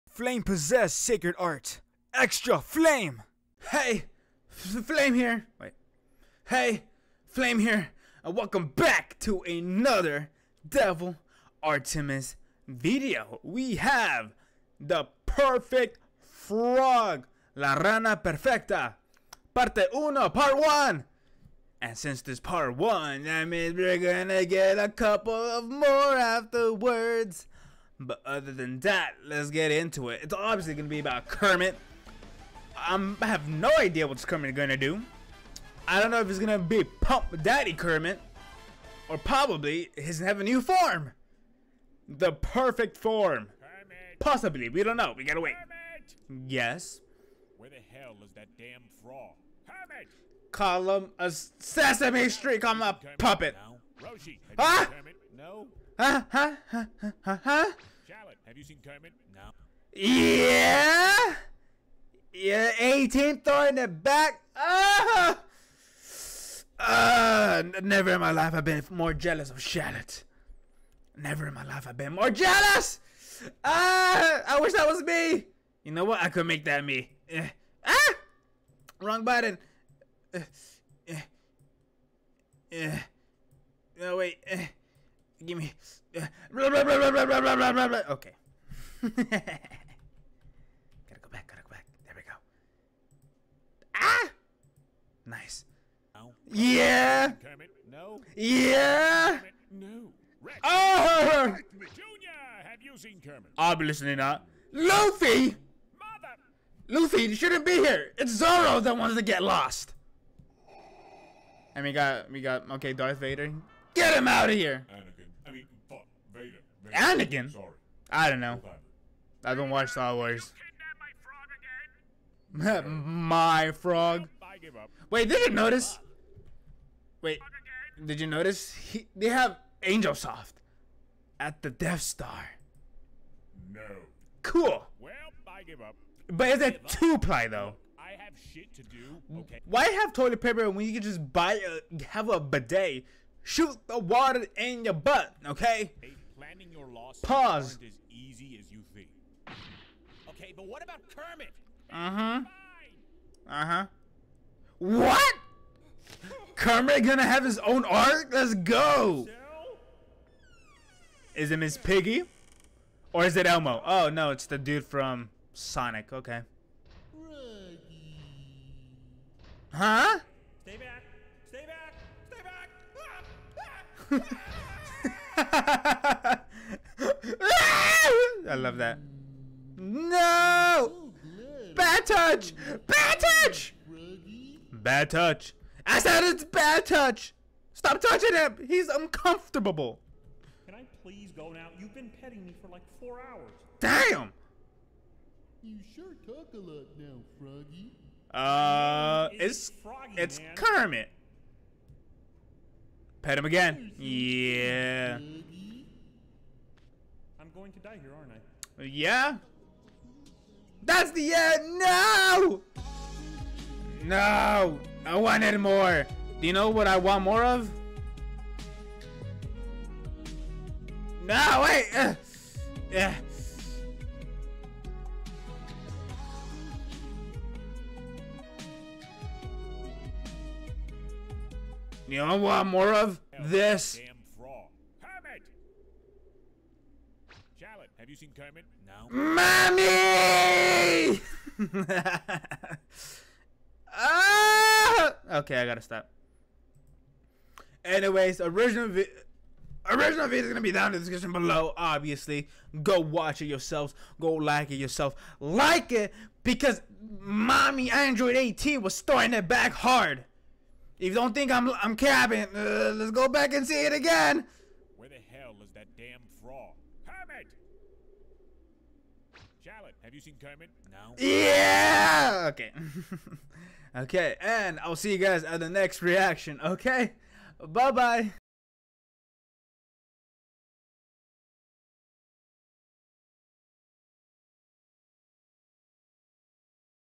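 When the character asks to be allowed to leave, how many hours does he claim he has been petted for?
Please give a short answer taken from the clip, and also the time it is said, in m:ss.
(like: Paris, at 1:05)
4, at 3:12.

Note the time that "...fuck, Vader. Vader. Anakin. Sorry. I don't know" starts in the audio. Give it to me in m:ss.
1:55.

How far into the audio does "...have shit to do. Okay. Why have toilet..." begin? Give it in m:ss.
2:18.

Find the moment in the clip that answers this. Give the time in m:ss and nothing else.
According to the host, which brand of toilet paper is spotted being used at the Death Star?
2:09.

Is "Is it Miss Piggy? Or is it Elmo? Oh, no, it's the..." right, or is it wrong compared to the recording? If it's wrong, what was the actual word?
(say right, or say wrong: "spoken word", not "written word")
right.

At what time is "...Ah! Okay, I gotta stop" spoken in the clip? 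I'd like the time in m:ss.
4:03.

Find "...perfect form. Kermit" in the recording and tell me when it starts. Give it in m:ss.
0:42.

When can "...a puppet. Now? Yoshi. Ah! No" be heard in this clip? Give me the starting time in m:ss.
0:52.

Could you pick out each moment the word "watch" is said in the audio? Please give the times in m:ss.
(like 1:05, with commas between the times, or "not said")
1:59, 4:12.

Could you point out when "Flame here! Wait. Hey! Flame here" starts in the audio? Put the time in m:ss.
0:04.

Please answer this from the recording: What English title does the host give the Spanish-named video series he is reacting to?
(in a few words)
The perfect frog.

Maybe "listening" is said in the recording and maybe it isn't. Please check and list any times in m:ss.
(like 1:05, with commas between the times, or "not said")
1:43.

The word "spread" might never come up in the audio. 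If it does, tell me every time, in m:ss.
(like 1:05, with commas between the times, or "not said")
not said.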